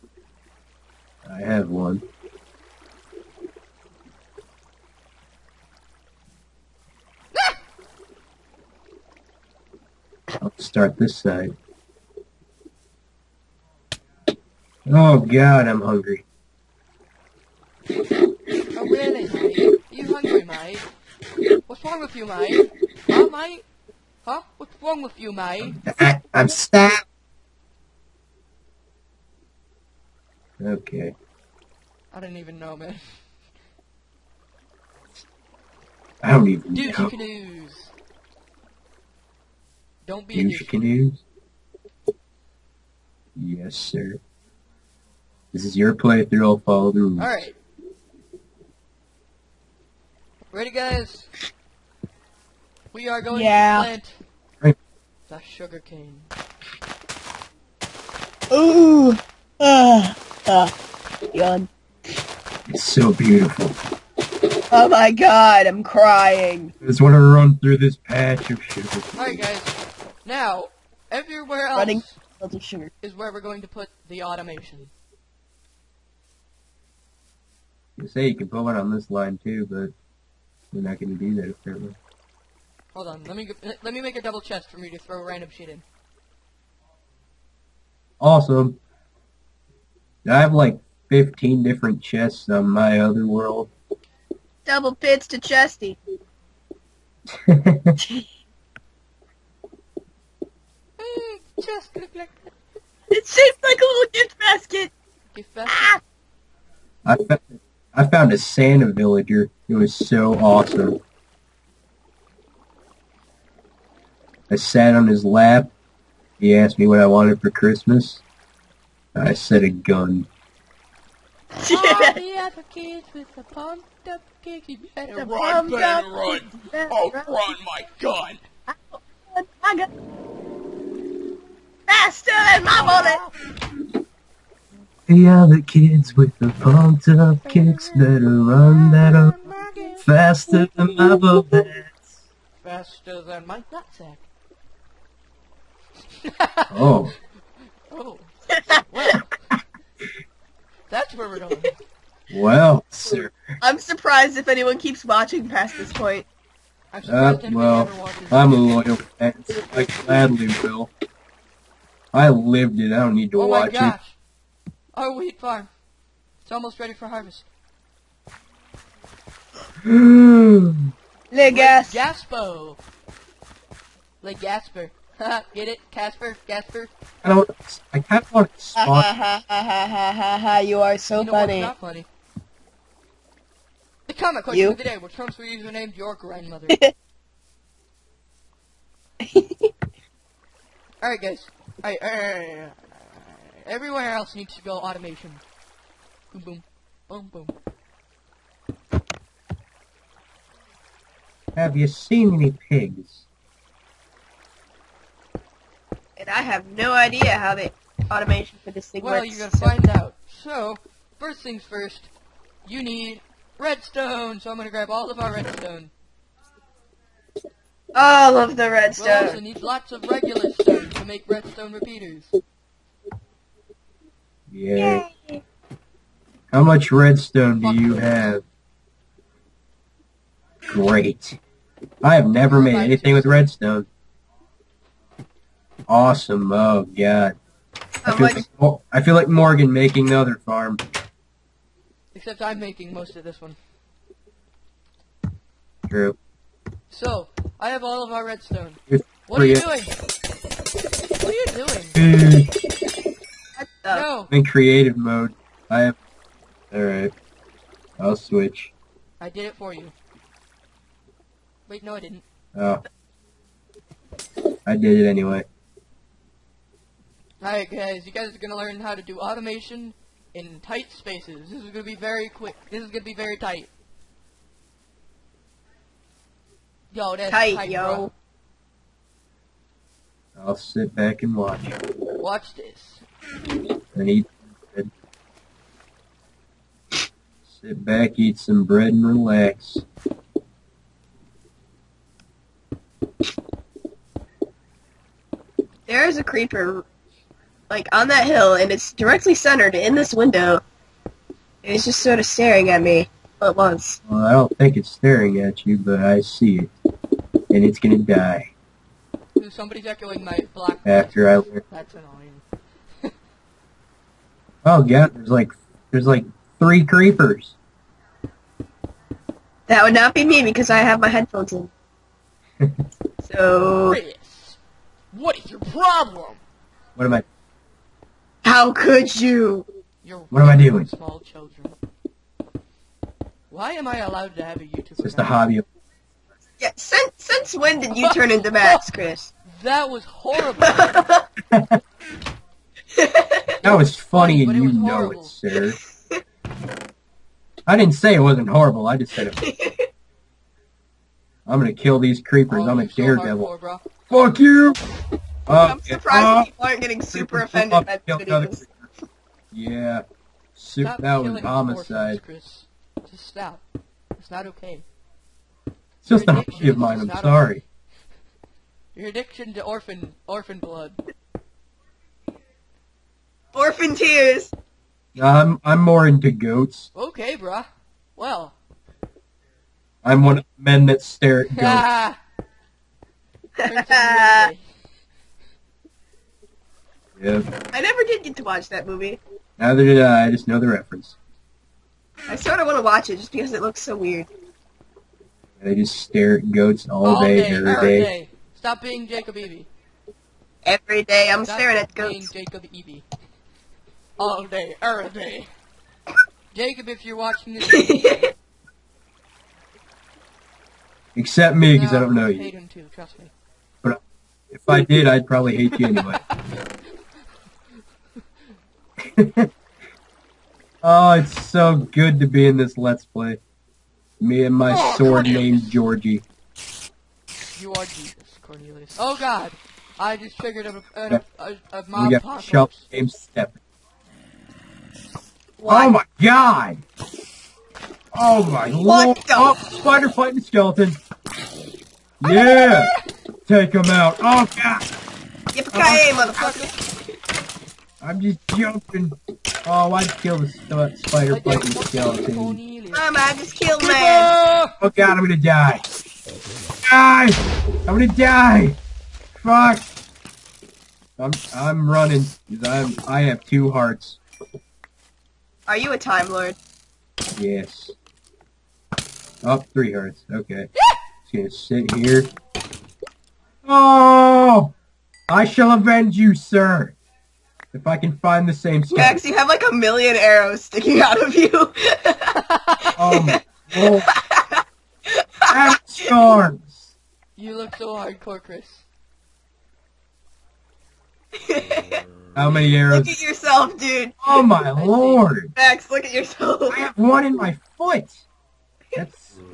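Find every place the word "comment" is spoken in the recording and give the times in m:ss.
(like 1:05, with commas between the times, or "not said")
3:04.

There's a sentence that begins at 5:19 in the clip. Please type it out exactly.
That would not be me because I have my headphones in.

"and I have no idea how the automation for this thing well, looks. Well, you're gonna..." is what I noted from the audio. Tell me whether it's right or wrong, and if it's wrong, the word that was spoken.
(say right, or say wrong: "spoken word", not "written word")
wrong: "works", not "looks".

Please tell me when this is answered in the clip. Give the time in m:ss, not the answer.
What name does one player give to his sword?
7:05.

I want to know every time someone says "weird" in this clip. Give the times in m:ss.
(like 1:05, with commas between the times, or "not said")
6:33.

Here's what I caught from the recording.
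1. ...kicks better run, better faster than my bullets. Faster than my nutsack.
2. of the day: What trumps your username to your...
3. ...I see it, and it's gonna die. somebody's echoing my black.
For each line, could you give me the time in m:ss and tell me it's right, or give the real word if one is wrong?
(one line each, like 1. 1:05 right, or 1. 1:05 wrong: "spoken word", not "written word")
1. 2:17 right
2. 3:04 right
3. 5:05 right.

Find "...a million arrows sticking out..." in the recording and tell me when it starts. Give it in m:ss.
7:59.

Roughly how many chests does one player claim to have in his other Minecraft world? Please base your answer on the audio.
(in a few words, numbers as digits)
15.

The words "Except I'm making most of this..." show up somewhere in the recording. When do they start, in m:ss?
4:02.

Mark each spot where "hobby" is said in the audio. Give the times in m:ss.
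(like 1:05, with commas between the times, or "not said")
5:35, 6:06.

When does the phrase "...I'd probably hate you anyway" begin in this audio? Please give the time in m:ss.
6:55.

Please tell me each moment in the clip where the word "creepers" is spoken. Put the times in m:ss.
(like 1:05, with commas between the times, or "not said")
4:56, 5:16, 5:52.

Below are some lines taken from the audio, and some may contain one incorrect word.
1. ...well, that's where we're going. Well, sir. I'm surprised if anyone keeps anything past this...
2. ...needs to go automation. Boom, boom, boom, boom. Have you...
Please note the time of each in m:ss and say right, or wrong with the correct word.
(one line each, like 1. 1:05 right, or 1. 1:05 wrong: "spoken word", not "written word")
1. 2:28 wrong: "watching", not "anything"
2. 3:14 right.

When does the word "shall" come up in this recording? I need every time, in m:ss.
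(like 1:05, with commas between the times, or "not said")
7:55.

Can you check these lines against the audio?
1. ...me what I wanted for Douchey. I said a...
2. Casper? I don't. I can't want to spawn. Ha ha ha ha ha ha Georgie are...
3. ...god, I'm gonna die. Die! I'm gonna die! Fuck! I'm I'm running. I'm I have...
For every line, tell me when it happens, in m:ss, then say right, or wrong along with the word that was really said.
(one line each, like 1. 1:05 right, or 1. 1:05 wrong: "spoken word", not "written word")
1. 1:56 wrong: "Christmas", not "Douchey"
2. 2:56 wrong: "You", not "Georgie"
3. 7:34 right.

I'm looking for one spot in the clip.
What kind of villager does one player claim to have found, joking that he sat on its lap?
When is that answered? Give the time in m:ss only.
1:48.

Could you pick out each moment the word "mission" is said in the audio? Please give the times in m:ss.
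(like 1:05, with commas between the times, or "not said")
not said.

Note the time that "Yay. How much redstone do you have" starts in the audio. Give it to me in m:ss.
3:45.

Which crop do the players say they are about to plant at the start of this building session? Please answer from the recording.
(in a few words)
sugarcane.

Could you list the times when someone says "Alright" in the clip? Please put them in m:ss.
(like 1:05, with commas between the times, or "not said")
1:09, 4:16, 4:27.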